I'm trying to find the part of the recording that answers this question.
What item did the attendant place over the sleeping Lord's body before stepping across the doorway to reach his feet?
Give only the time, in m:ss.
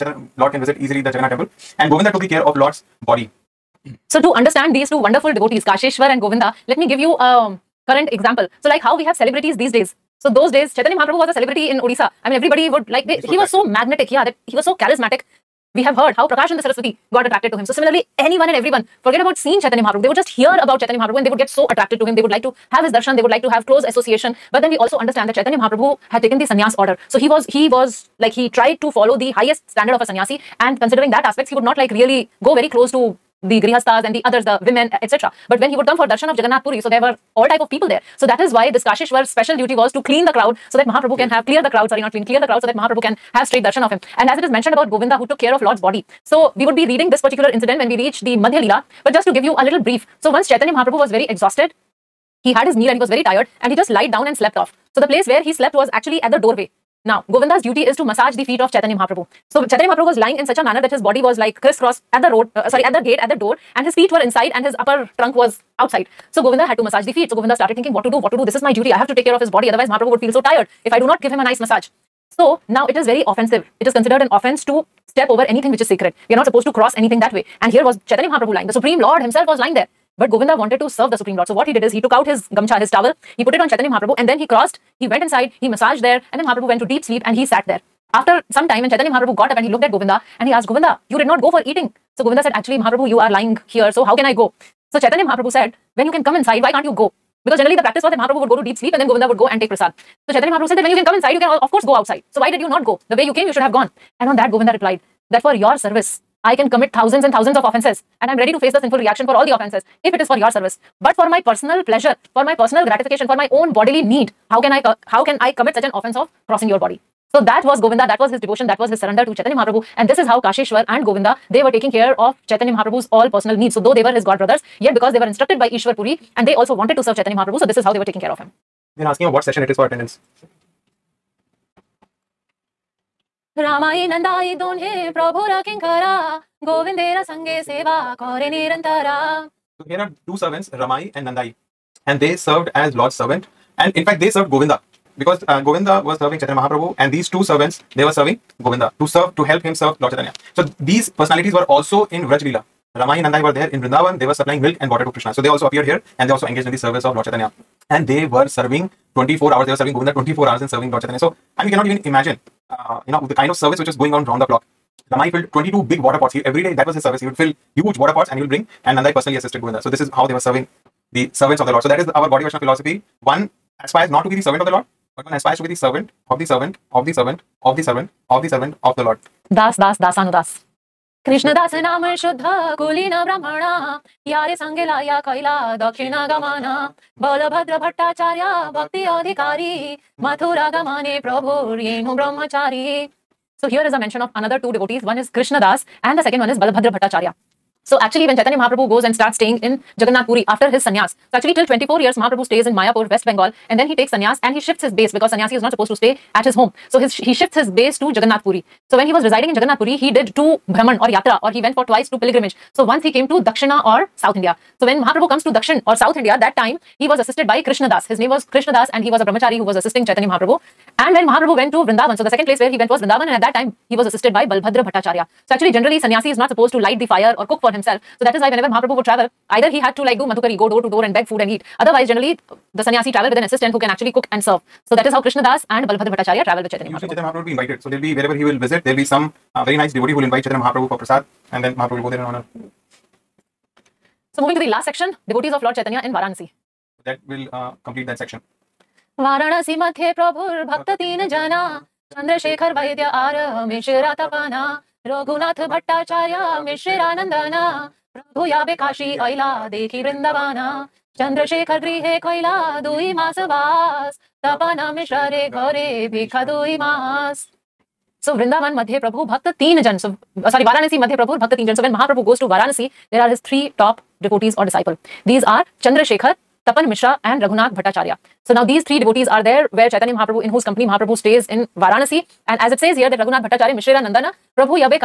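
1:22.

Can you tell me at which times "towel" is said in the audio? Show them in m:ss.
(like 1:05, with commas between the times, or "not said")
1:22.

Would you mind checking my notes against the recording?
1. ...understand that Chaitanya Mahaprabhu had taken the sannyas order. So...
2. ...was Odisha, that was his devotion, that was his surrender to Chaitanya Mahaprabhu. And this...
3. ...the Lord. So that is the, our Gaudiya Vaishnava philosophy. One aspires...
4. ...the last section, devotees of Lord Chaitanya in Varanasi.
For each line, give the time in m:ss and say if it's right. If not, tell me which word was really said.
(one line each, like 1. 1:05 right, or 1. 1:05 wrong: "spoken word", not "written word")
1. 0:24 right
2. 1:57 wrong: "Govinda", not "Odisha"
3. 2:51 right
4. 4:04 right.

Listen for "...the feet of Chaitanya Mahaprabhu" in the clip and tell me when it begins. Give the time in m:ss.
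0:58.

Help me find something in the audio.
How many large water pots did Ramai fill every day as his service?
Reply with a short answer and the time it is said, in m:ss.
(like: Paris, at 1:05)
22, at 2:45.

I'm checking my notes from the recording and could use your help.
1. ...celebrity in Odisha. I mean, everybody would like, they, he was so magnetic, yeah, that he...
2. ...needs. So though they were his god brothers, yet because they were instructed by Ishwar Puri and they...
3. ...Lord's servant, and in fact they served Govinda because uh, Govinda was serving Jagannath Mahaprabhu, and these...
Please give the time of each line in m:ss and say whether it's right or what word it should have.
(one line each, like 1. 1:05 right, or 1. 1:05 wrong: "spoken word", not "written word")
1. 0:11 right
2. 2:03 right
3. 2:22 wrong: "Chaitanya", not "Jagannath".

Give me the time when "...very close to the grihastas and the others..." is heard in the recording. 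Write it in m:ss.
0:32.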